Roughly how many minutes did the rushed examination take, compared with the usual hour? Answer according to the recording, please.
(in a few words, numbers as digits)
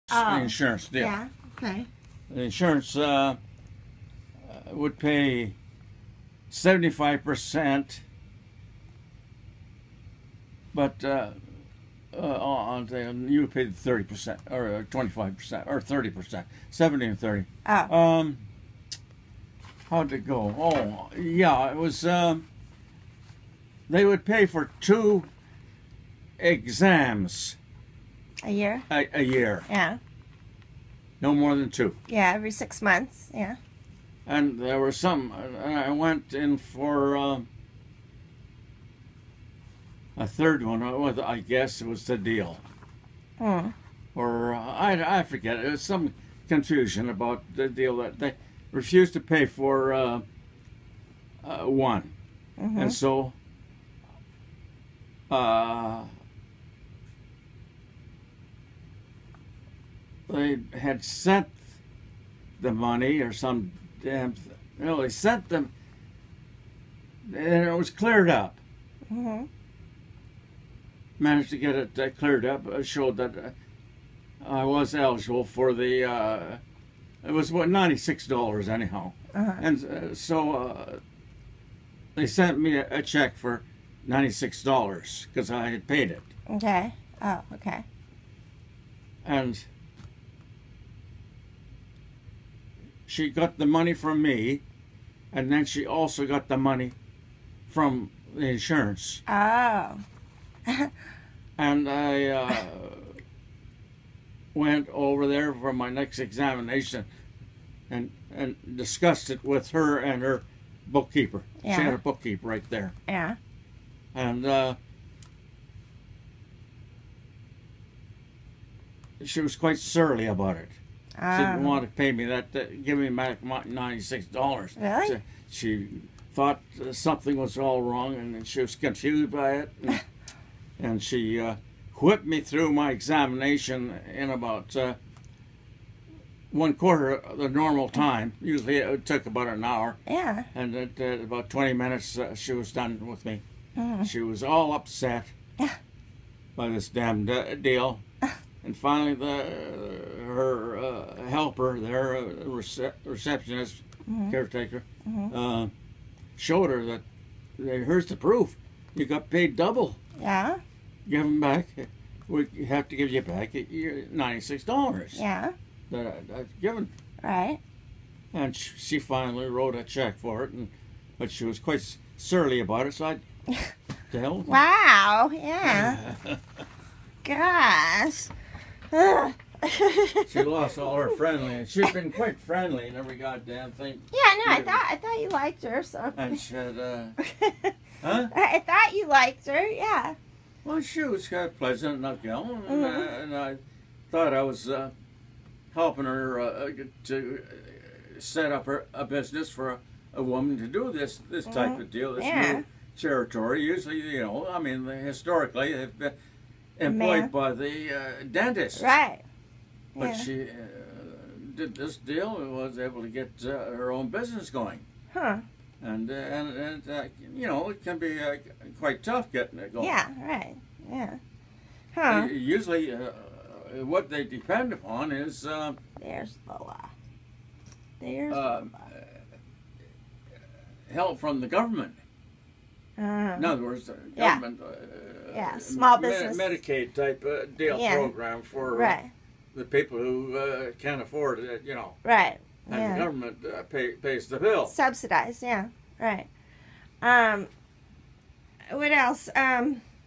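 20 minutes.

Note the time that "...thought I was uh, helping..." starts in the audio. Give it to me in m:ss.
3:14.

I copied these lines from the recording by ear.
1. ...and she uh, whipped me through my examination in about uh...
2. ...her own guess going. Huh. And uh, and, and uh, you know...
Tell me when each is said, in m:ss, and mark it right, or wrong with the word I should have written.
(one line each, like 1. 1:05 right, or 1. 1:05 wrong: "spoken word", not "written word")
1. 2:10 right
2. 3:33 wrong: "business", not "guess".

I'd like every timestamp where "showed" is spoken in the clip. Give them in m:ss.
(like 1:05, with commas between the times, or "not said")
1:12, 2:36.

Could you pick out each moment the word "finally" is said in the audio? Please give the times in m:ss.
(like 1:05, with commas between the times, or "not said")
2:28, 2:48.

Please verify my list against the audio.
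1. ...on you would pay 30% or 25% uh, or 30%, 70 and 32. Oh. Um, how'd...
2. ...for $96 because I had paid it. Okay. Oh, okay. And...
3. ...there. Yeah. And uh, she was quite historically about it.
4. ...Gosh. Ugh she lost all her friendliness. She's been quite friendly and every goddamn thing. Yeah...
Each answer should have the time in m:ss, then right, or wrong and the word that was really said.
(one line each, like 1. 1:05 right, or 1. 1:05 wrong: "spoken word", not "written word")
1. 0:12 wrong: "30", not "32"
2. 1:23 right
3. 1:52 wrong: "surly", not "historically"
4. 2:57 right.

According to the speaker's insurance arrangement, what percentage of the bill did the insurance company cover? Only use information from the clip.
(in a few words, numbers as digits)
75%.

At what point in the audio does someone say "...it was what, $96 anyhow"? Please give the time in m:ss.
1:17.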